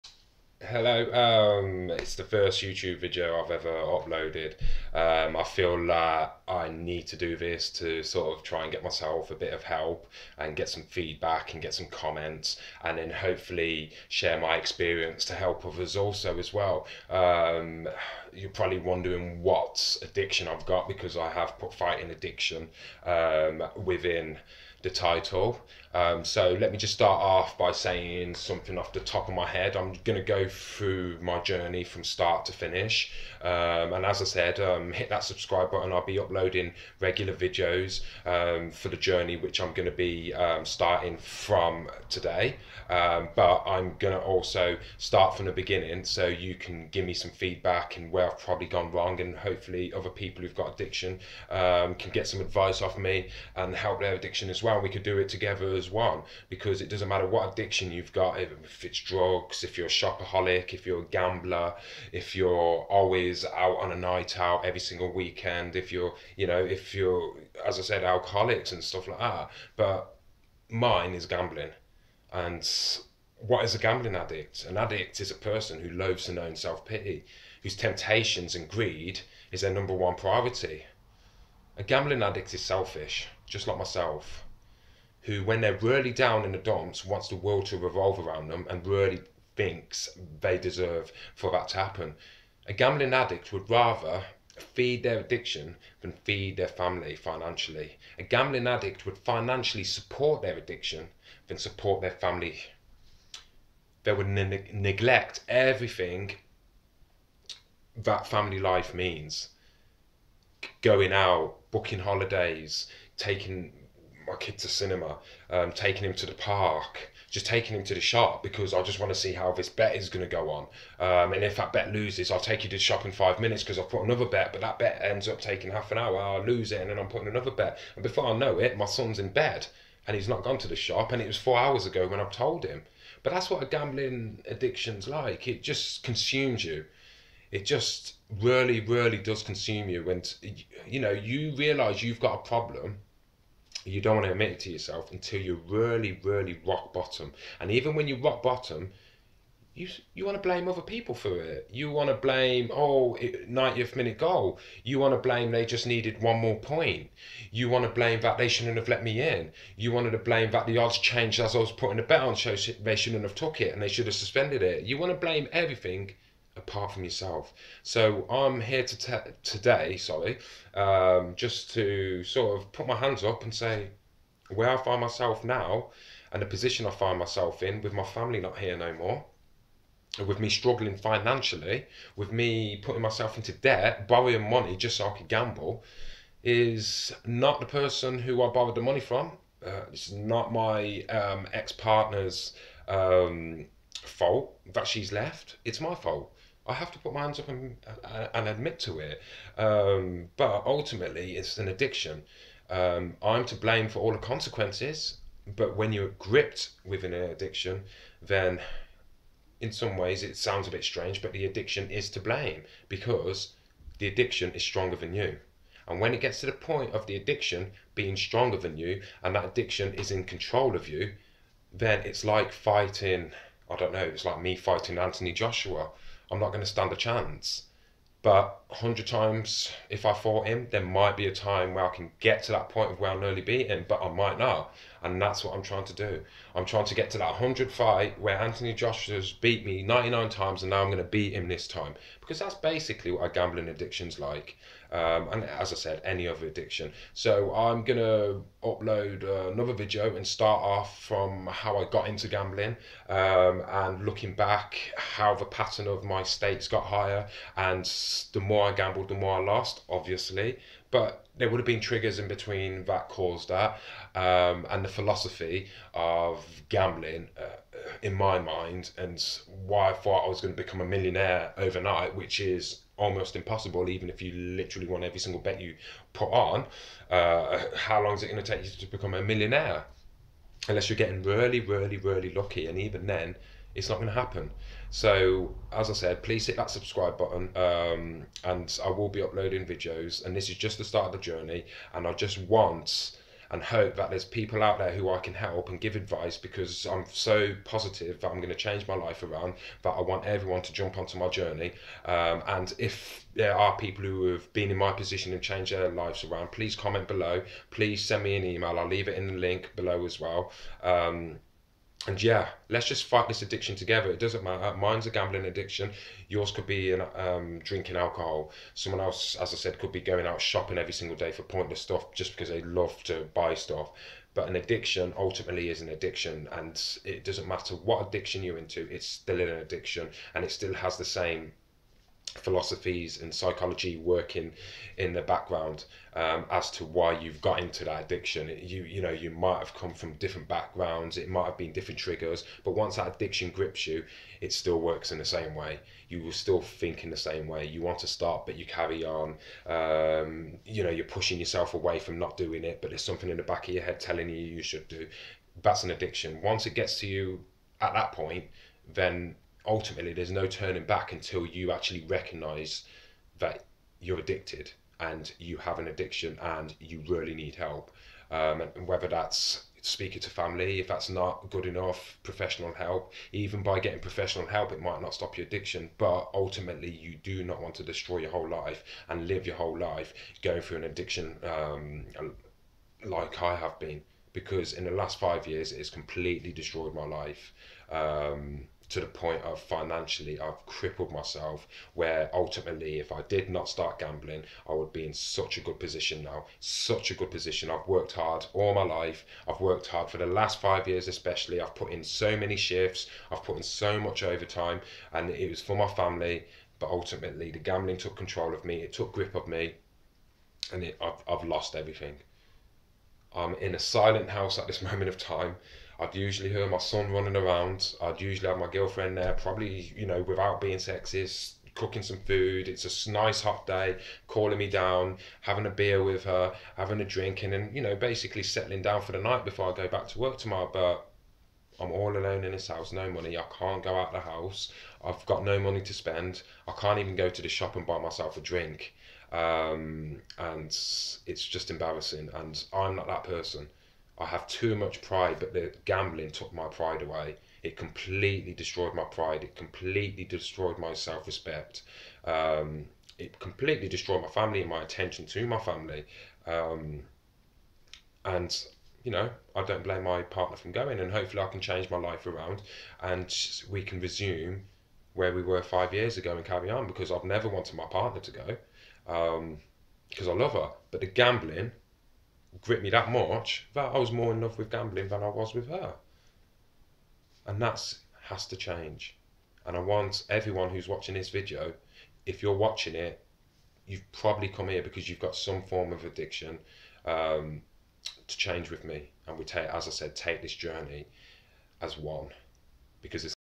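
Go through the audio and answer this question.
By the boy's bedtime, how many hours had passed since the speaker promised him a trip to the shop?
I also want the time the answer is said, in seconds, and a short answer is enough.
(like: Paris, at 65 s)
4, at 131 s.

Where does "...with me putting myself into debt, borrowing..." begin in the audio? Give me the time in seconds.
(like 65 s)
182 s.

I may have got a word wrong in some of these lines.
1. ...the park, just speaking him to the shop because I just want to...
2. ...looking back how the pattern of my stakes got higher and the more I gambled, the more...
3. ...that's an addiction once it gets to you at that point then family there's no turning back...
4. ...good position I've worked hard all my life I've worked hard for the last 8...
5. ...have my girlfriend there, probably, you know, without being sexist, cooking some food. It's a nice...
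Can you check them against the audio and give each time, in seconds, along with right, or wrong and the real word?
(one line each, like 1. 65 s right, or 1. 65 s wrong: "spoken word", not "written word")
1. 116 s wrong: "taking", not "speaking"
2. 254 s right
3. 355 s wrong: "ultimately", not "family"
4. 397 s wrong: "5", not "8"
5. 418 s right.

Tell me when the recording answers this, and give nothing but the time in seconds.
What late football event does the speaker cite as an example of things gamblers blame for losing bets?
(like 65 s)
153 s.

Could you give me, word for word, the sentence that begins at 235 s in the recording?
And that's what I'm trying to do.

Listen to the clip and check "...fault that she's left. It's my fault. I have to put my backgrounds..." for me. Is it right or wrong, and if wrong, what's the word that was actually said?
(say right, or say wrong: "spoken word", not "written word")
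wrong: "hands", not "backgrounds".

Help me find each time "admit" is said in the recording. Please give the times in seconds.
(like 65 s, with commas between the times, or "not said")
144 s, 198 s.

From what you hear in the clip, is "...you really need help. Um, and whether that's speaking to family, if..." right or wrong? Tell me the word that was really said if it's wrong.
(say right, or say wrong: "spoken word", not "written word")
right.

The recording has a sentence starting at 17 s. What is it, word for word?
Um, you're probably wondering what addiction I've got because I have put fighting addiction um, within the title.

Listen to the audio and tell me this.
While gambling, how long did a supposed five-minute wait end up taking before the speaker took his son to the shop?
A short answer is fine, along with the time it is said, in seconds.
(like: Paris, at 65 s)
Half an hour, at 125 s.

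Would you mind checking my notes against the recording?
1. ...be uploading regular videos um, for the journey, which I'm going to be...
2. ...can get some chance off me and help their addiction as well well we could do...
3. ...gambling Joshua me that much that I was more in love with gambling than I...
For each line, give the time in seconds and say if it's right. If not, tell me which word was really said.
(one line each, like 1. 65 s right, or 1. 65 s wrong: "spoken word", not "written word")
1. 36 s right
2. 51 s wrong: "advice", not "chance"
3. 471 s wrong: "Grip", not "Joshua".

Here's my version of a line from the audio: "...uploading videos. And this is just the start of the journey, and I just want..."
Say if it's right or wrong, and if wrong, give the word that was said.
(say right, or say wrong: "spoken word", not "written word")
right.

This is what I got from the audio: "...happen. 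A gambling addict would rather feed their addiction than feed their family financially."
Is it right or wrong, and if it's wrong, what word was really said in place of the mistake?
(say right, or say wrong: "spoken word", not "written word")
right.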